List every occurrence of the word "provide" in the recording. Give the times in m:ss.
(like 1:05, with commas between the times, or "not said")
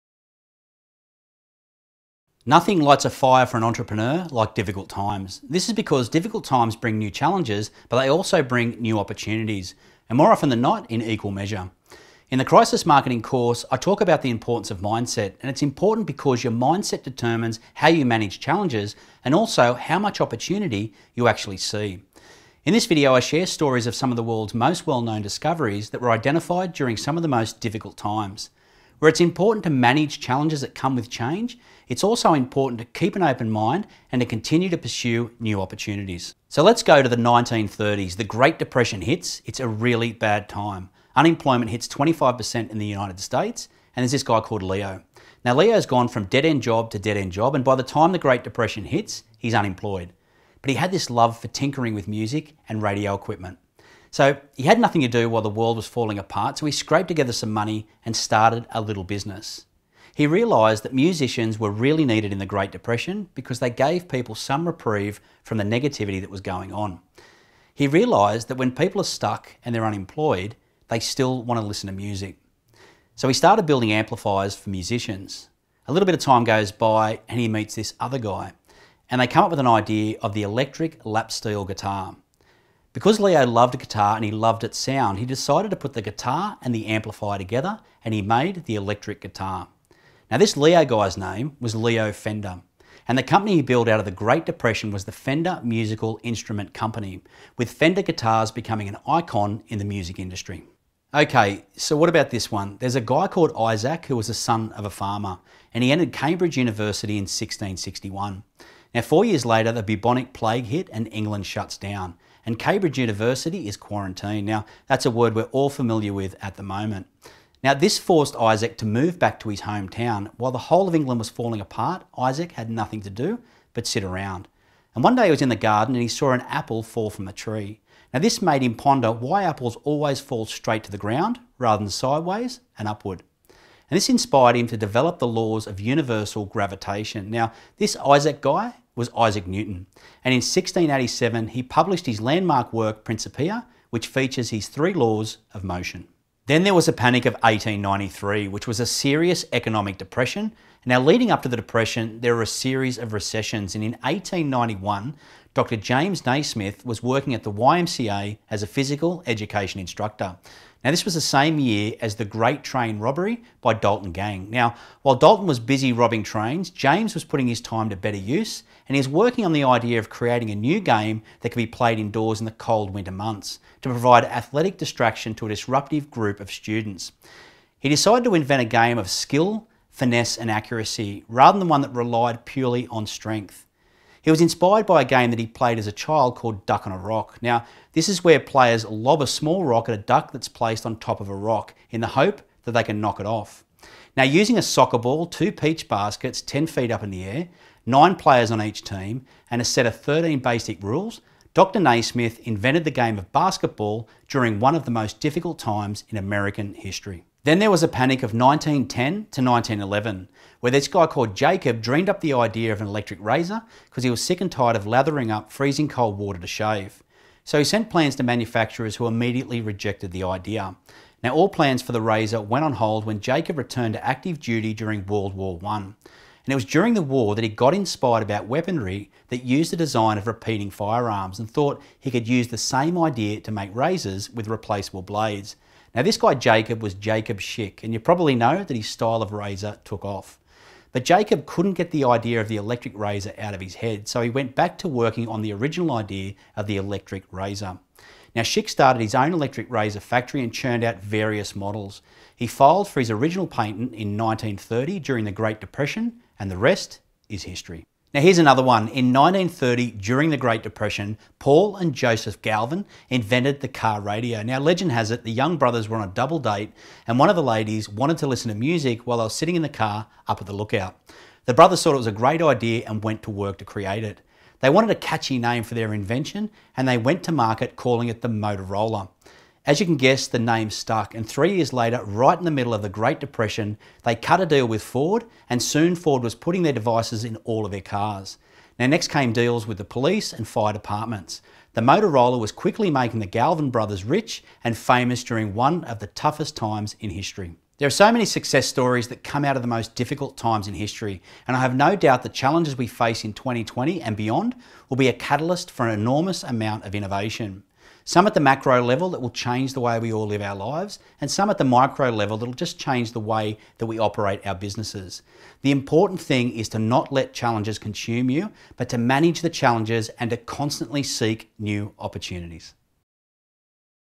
2:53.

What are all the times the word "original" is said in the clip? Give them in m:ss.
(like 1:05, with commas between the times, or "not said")
4:05, 4:13.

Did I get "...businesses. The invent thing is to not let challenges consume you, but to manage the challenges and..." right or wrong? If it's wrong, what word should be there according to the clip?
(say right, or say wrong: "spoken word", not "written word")
wrong: "important", not "invent".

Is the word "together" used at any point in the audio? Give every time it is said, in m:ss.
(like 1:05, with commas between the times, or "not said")
0:57, 1:27.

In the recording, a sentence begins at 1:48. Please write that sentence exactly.
Now, four years later, the bubonic plague hit and England shuts down, and Cambridge University is quarantined.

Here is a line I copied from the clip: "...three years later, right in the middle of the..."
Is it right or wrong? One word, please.
right.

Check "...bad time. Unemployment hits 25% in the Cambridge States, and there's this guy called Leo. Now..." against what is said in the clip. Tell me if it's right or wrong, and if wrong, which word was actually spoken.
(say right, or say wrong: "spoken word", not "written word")
wrong: "United", not "Cambridge".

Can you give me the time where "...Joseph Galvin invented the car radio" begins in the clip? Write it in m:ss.
4:21.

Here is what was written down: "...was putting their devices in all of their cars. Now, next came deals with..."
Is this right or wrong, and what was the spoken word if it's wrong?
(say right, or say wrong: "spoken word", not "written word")
right.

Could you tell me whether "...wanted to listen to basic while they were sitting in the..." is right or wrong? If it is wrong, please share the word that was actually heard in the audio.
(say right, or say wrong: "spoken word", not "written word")
wrong: "music", not "basic".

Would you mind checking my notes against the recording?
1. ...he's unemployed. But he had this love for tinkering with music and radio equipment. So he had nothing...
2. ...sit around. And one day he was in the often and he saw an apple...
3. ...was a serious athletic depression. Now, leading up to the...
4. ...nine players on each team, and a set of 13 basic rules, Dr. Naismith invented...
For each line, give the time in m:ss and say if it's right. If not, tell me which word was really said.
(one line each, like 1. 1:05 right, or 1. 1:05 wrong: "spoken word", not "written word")
1. 0:49 right
2. 2:03 wrong: "garden", not "often"
3. 2:28 wrong: "economic", not "athletic"
4. 3:17 right.